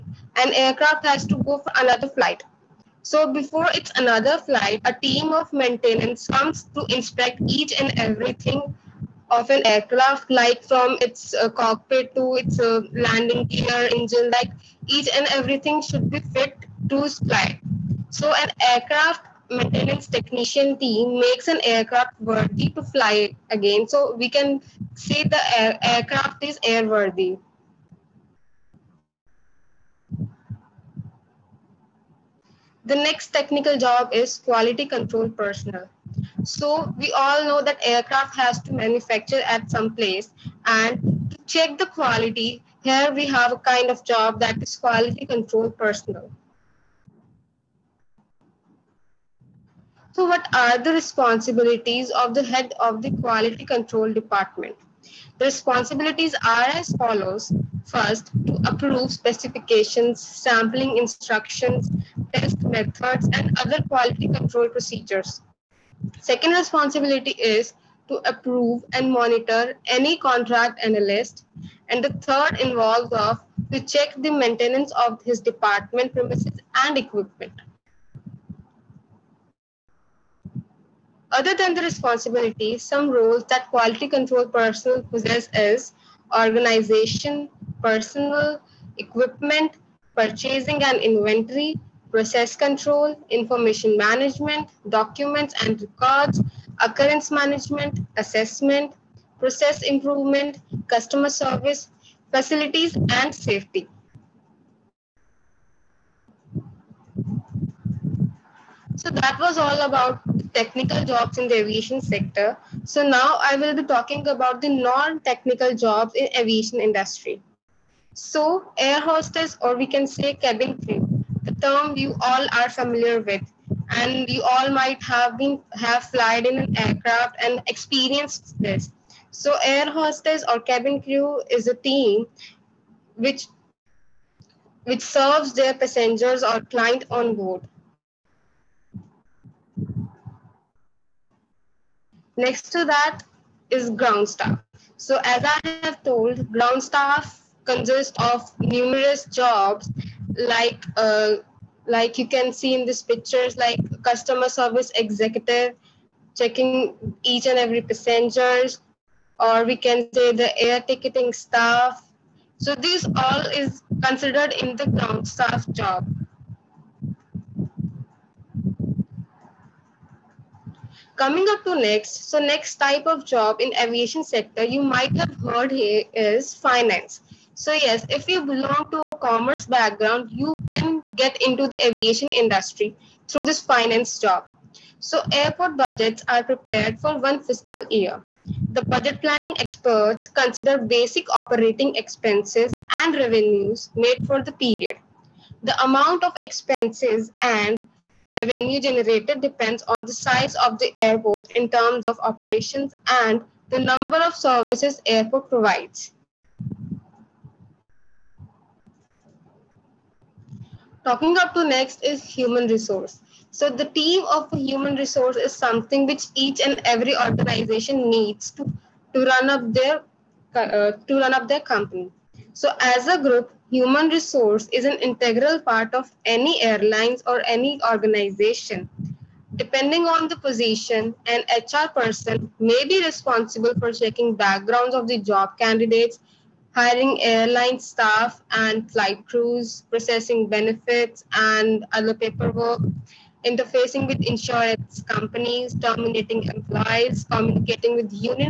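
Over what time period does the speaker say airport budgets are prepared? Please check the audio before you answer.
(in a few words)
one fiscal year.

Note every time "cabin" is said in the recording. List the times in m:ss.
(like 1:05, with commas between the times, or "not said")
2:00, 2:10.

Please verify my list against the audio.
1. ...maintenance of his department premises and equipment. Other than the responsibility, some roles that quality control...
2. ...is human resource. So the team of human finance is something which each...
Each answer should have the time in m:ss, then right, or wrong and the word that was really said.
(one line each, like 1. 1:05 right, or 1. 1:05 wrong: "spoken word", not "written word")
1. 1:14 right
2. 3:32 wrong: "resource", not "finance".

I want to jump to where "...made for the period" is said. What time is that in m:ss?
3:13.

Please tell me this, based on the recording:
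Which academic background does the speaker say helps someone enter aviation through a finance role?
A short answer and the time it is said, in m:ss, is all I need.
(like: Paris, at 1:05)
commerce, at 2:59.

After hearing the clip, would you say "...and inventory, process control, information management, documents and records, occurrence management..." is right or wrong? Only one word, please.
right.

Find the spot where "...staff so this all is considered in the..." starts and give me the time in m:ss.
2:41.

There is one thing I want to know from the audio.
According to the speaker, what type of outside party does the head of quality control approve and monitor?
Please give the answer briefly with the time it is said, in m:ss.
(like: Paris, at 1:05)
contract analyst, at 1:10.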